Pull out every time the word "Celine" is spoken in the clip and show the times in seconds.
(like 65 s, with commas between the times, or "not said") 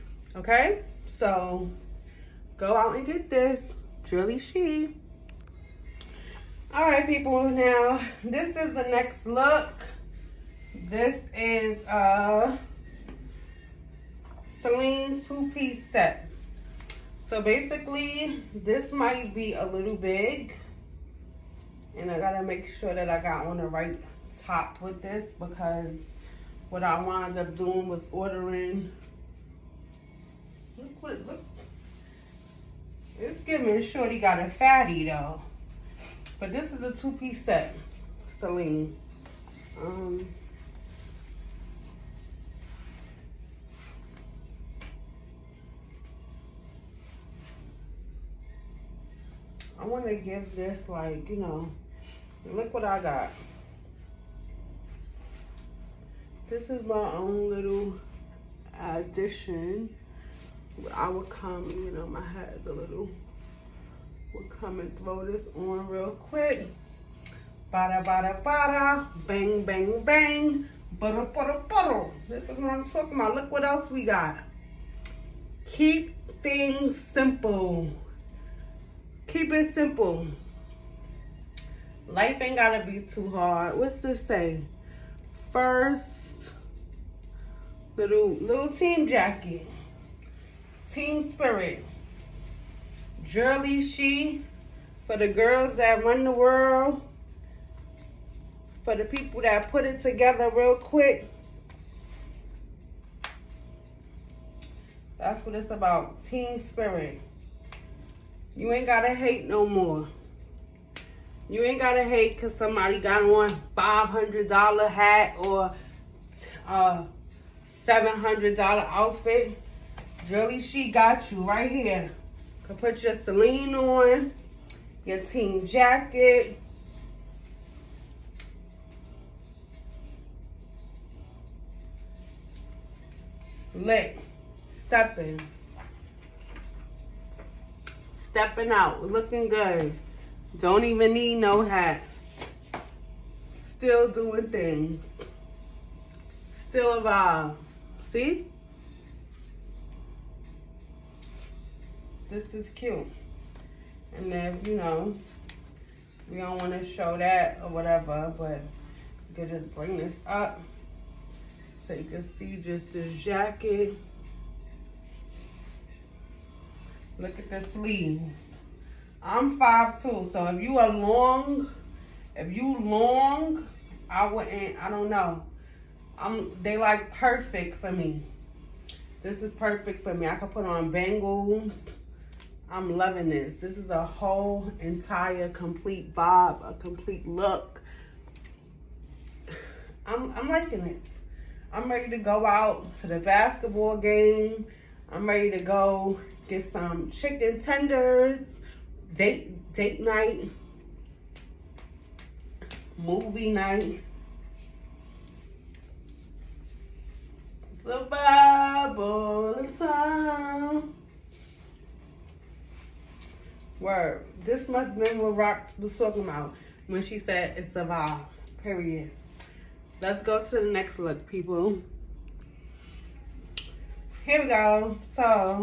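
14 s, 38 s, 123 s.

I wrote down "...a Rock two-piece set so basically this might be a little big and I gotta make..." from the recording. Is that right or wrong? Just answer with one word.
wrong.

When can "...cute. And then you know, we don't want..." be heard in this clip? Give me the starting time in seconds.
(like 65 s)
152 s.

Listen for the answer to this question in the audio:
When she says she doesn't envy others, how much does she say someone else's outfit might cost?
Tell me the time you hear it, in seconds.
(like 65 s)
117 s.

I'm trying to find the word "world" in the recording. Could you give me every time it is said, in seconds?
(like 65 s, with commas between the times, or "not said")
96 s.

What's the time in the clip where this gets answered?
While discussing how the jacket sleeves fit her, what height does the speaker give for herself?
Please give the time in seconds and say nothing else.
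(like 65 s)
169 s.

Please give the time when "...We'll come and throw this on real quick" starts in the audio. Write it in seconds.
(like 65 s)
64 s.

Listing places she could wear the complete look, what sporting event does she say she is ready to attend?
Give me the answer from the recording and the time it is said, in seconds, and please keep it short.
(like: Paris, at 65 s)
basketball game, at 193 s.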